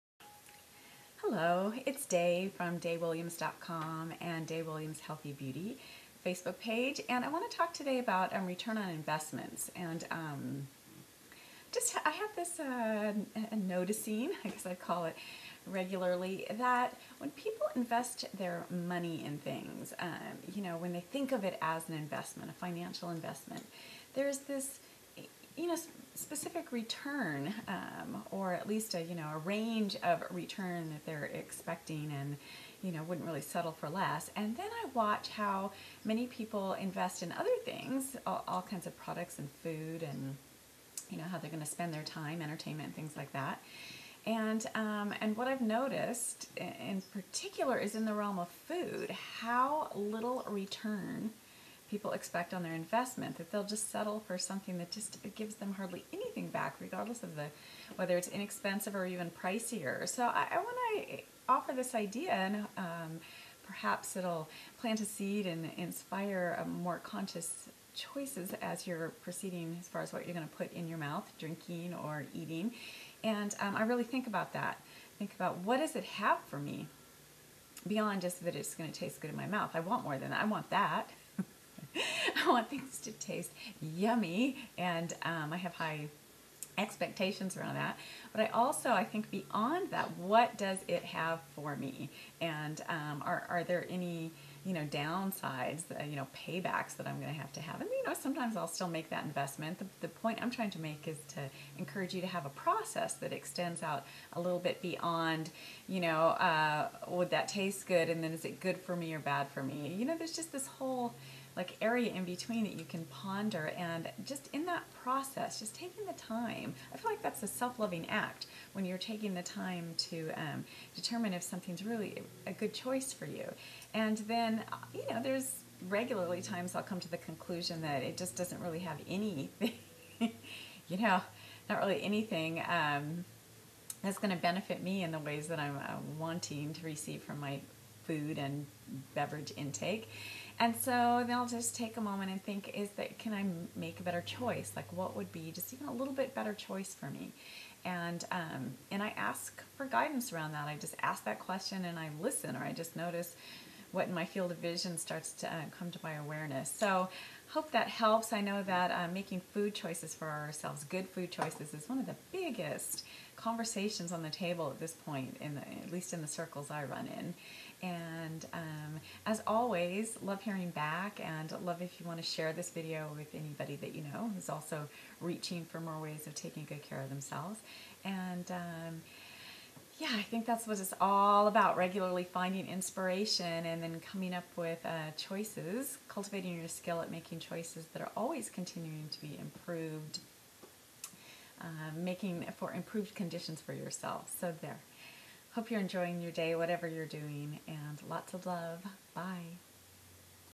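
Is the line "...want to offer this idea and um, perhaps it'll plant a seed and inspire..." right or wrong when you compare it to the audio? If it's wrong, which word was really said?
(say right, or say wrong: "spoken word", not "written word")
right.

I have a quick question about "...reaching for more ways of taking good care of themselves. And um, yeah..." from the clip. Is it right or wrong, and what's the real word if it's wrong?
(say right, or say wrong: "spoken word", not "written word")
right.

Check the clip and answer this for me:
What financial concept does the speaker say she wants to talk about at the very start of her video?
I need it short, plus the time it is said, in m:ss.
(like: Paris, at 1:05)
Return on investments, at 0:08.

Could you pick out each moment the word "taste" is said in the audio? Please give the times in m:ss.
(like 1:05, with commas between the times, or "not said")
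1:18, 1:23, 1:47.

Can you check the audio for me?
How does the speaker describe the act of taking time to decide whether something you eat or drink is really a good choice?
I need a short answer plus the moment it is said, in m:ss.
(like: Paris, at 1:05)
A self-loving act, at 1:57.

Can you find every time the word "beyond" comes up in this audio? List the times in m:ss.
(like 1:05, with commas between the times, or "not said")
1:17, 1:29, 1:44.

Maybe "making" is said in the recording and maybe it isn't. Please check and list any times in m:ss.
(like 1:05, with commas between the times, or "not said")
2:39, 3:07, 3:11.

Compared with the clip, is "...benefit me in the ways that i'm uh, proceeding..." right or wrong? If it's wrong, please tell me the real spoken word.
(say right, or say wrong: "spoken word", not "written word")
wrong: "wanting", not "proceeding".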